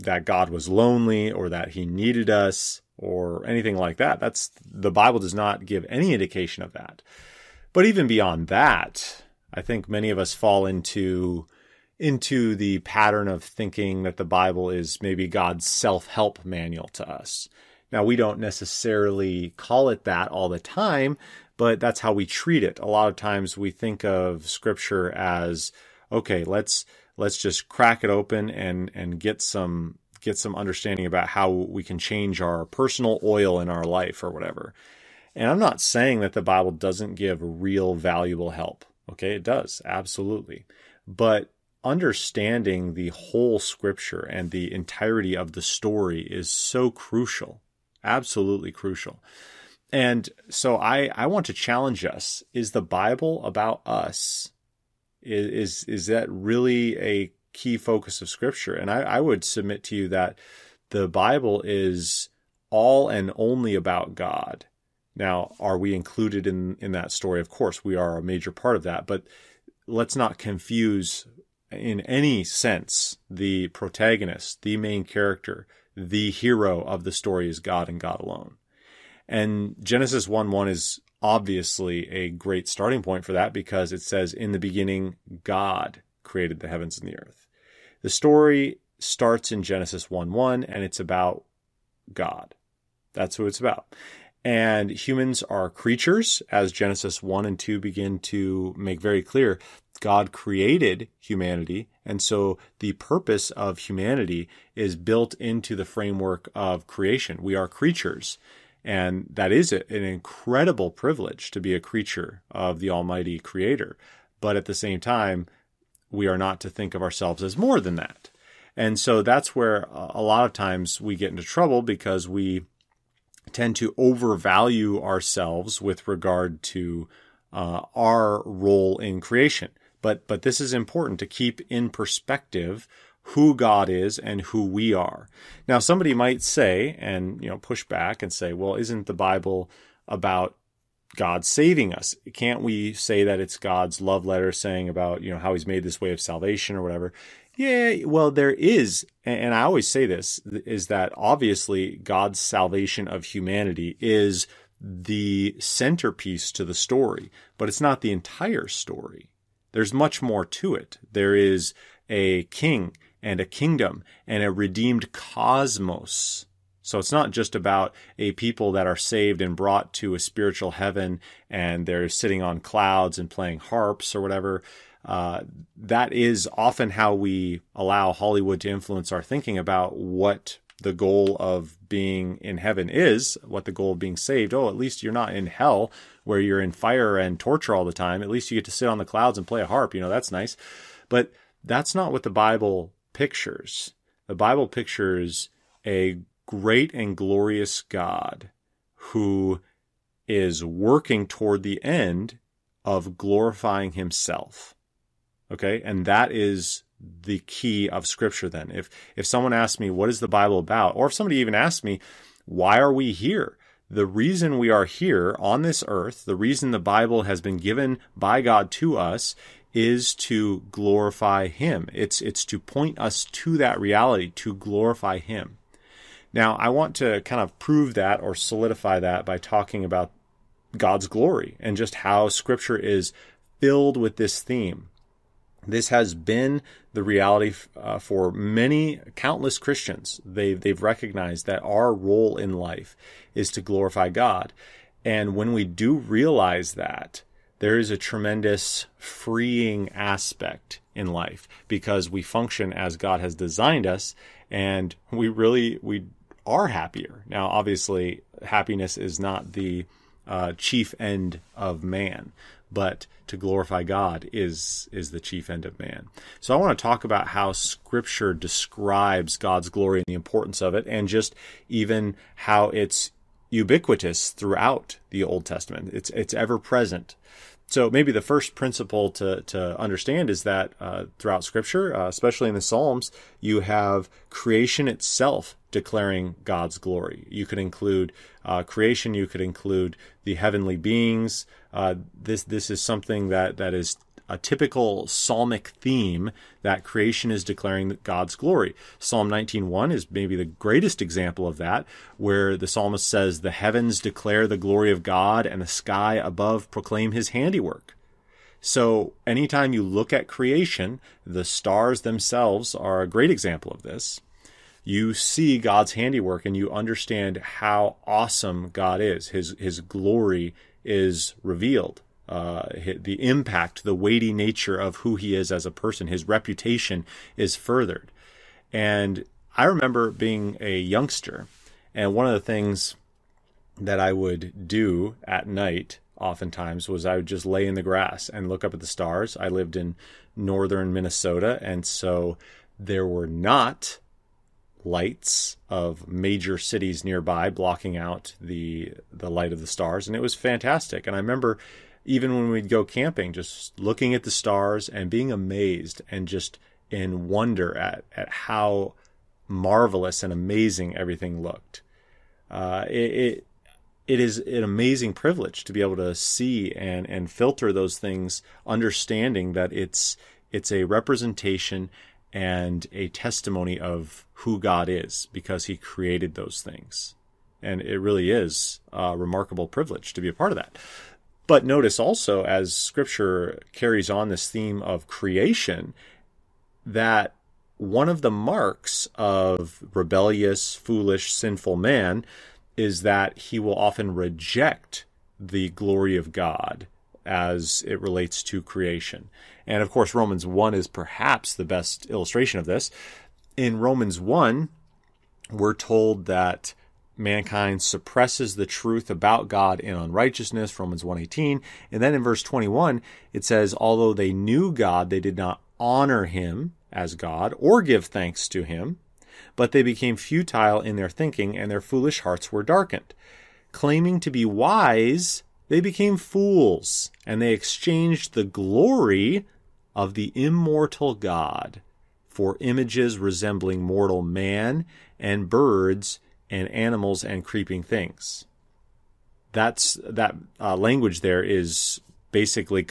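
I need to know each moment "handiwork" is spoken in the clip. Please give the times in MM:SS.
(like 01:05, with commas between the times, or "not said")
05:07, 05:15.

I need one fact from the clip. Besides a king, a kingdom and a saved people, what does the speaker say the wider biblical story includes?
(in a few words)
a redeemed cosmos.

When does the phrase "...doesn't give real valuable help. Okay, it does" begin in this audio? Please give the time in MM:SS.
00:36.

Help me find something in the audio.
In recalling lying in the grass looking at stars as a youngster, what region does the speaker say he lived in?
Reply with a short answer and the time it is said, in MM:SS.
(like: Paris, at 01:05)
northern Minnesota, at 05:40.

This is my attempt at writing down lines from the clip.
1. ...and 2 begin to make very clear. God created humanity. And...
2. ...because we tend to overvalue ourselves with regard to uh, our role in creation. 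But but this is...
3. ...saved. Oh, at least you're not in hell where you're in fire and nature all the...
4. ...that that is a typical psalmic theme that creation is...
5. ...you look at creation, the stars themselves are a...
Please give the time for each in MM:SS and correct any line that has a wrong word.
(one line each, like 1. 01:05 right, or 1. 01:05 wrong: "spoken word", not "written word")
1. 01:37 right
2. 02:01 right
3. 03:04 wrong: "torture", not "nature"
4. 04:53 right
5. 05:09 right.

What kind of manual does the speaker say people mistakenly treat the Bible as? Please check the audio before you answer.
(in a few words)
self help manual.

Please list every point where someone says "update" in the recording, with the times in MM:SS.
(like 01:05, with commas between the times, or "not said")
not said.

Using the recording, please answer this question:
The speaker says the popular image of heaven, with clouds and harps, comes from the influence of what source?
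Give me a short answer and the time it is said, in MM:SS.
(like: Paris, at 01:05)
Hollywood, at 02:58.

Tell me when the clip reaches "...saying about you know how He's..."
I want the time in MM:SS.
02:24.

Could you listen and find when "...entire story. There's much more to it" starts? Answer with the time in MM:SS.
02:38.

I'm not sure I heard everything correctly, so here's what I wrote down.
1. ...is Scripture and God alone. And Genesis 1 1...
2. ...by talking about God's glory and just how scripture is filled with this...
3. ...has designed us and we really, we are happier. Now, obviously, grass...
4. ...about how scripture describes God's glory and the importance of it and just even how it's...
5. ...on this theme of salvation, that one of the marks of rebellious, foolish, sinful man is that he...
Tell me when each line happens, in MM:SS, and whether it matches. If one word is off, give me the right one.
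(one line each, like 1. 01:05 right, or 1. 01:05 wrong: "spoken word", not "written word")
1. 01:17 wrong: "God", not "Scripture"
2. 03:49 right
3. 04:13 wrong: "happiness", not "grass"
4. 04:27 right
5. 06:24 wrong: "creation", not "salvation".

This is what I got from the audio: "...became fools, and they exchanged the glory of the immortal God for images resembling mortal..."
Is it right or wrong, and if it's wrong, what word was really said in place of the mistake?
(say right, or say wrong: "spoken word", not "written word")
right.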